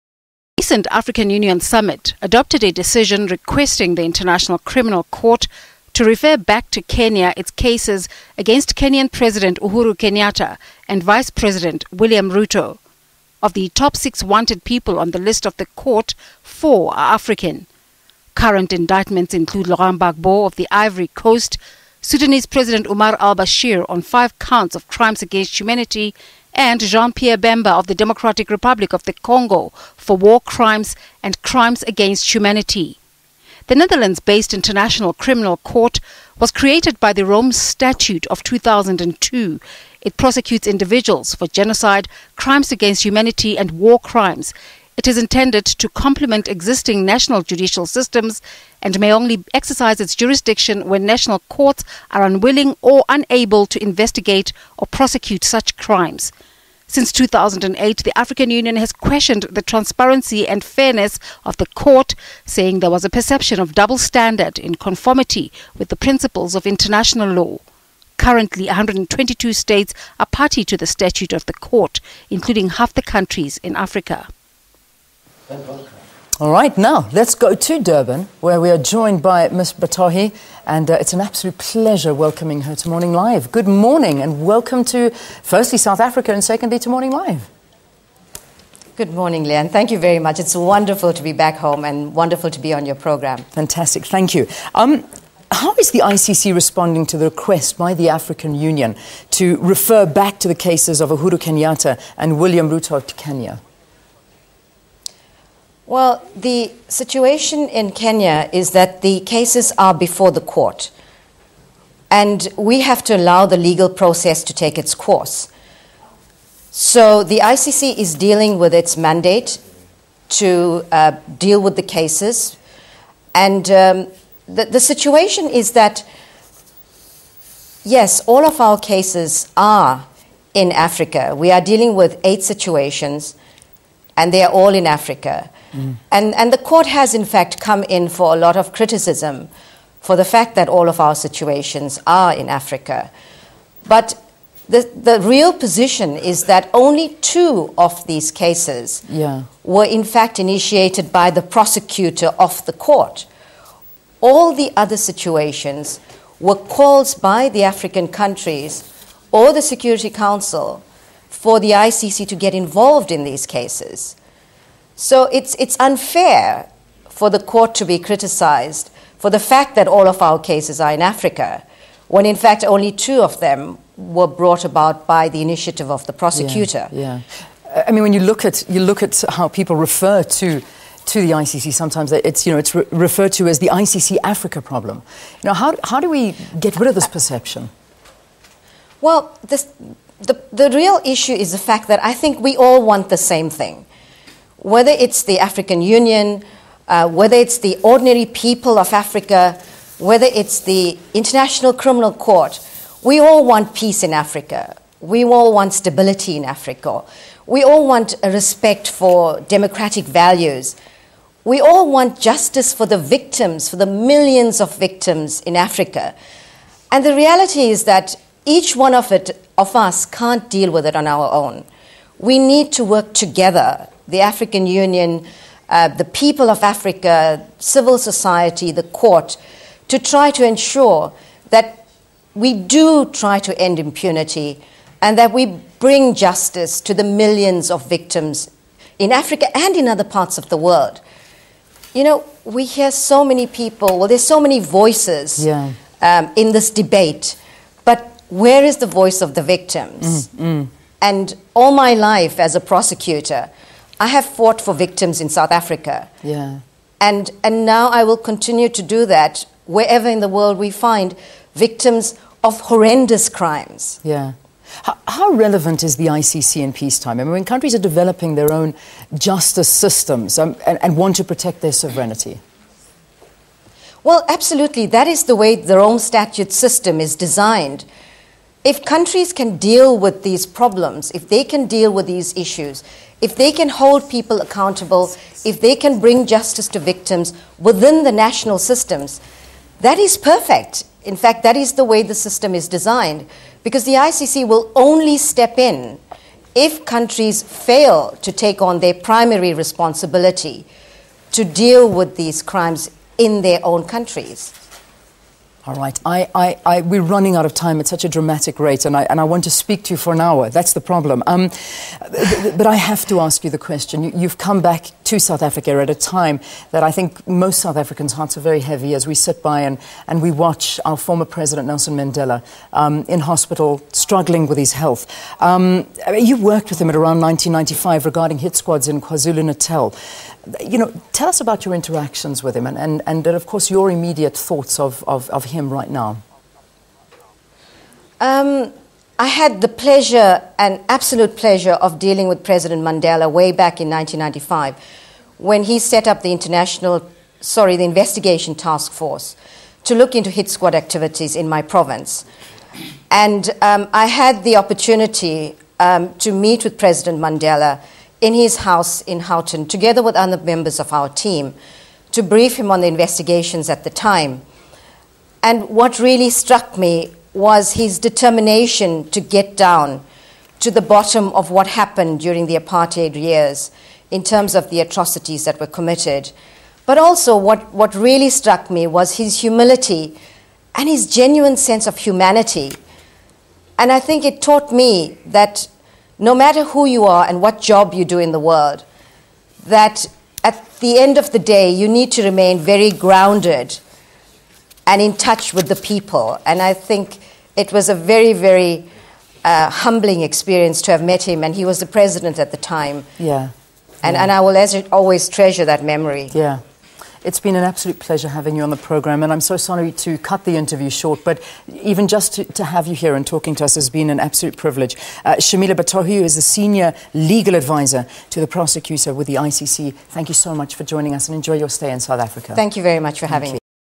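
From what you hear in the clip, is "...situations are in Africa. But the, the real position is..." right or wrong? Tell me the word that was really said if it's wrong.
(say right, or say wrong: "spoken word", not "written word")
right.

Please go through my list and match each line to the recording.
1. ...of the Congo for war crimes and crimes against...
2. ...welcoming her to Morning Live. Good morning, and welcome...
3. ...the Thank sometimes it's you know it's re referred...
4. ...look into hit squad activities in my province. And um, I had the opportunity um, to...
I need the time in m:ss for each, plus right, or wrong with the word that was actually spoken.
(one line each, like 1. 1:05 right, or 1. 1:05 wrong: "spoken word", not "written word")
1. 0:28 right
2. 1:22 right
3. 3:01 wrong: "ICC", not "Thank"
4. 5:49 right.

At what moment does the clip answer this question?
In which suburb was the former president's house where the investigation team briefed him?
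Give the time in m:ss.
5:59.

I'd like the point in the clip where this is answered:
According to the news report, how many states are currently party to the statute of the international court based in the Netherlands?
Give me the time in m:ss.
1:08.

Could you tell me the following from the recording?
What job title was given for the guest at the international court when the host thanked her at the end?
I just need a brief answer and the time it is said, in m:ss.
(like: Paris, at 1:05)
Senior legal advisor, at 6:56.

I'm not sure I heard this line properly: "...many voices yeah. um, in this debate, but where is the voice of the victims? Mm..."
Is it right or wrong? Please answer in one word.
right.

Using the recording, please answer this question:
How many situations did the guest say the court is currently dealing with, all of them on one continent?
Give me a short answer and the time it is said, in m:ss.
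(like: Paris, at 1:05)
8, at 2:12.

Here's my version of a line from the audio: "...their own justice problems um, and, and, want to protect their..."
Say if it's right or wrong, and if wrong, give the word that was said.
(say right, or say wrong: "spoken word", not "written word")
wrong: "systems", not "problems".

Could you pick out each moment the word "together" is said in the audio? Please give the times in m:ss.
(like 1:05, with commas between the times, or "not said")
3:43, 5:59.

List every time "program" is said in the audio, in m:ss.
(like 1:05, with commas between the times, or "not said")
1:32, 6:48.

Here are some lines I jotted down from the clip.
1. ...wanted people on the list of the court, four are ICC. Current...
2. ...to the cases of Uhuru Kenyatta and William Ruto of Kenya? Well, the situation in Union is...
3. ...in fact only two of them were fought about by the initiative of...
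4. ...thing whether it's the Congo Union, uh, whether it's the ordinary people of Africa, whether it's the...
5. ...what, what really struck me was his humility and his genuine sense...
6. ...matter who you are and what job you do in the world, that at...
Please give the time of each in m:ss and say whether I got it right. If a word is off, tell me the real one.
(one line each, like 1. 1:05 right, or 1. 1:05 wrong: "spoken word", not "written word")
1. 0:14 wrong: "African", not "ICC"
2. 1:40 wrong: "Kenya", not "Union"
3. 2:52 wrong: "brought", not "fought"
4. 3:13 wrong: "African", not "Congo"
5. 6:17 right
6. 6:26 right.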